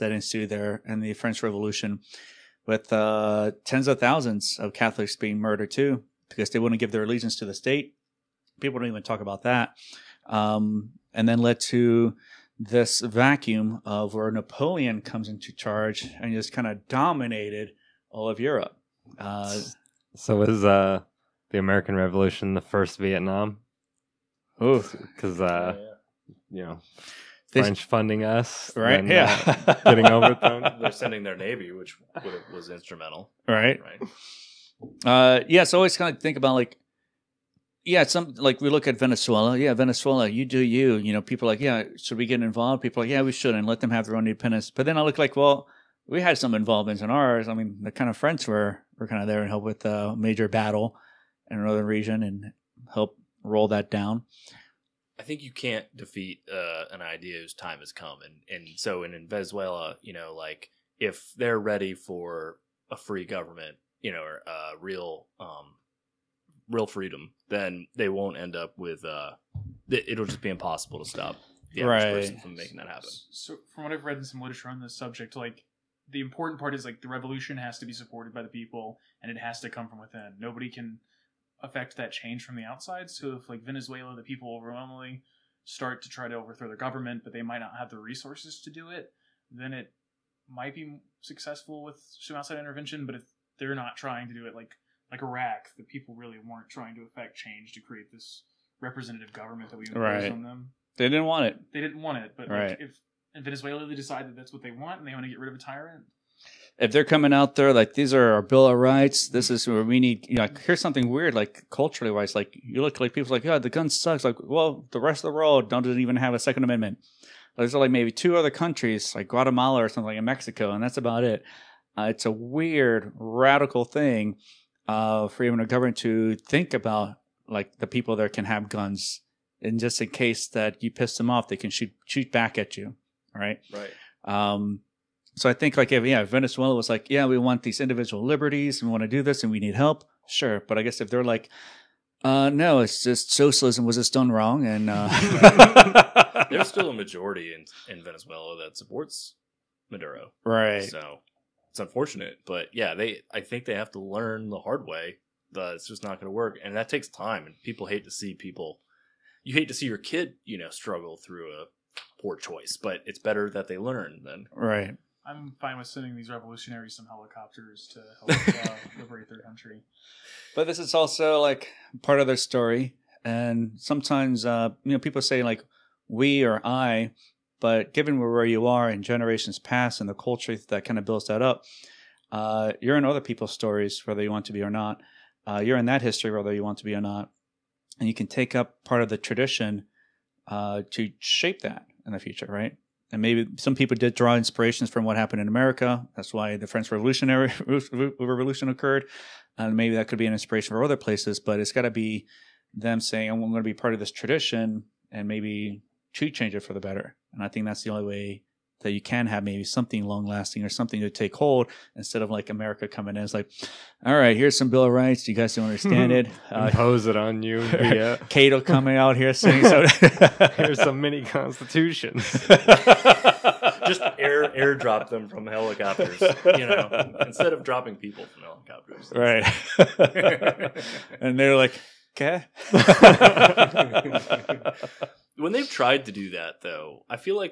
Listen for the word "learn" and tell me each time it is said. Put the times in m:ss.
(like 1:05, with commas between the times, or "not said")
2:33, 2:43.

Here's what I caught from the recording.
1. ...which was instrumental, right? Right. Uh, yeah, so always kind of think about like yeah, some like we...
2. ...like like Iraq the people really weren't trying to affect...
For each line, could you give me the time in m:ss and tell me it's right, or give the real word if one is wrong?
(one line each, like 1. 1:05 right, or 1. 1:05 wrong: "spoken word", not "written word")
1. 0:31 right
2. 1:34 right.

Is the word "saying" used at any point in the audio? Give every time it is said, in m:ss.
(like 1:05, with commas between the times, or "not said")
3:22, 3:39.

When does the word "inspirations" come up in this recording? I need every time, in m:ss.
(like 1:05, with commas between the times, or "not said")
3:14, 3:20.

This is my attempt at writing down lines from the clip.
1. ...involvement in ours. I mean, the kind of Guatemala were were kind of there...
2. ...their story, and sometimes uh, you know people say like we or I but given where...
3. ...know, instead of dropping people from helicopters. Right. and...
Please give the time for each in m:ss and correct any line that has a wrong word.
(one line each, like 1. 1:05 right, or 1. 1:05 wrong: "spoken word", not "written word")
1. 0:46 wrong: "French", not "Guatemala"
2. 2:52 right
3. 3:46 right.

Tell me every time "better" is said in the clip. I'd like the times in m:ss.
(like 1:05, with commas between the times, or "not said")
2:43, 3:26.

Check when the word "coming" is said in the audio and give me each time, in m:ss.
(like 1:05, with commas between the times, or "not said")
1:47, 3:32, 3:38.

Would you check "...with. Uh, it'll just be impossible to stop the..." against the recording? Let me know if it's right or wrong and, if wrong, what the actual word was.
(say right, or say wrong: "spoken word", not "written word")
right.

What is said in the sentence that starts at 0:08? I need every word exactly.
People don't even talk about that.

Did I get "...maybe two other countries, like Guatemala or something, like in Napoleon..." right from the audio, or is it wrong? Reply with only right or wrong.
wrong.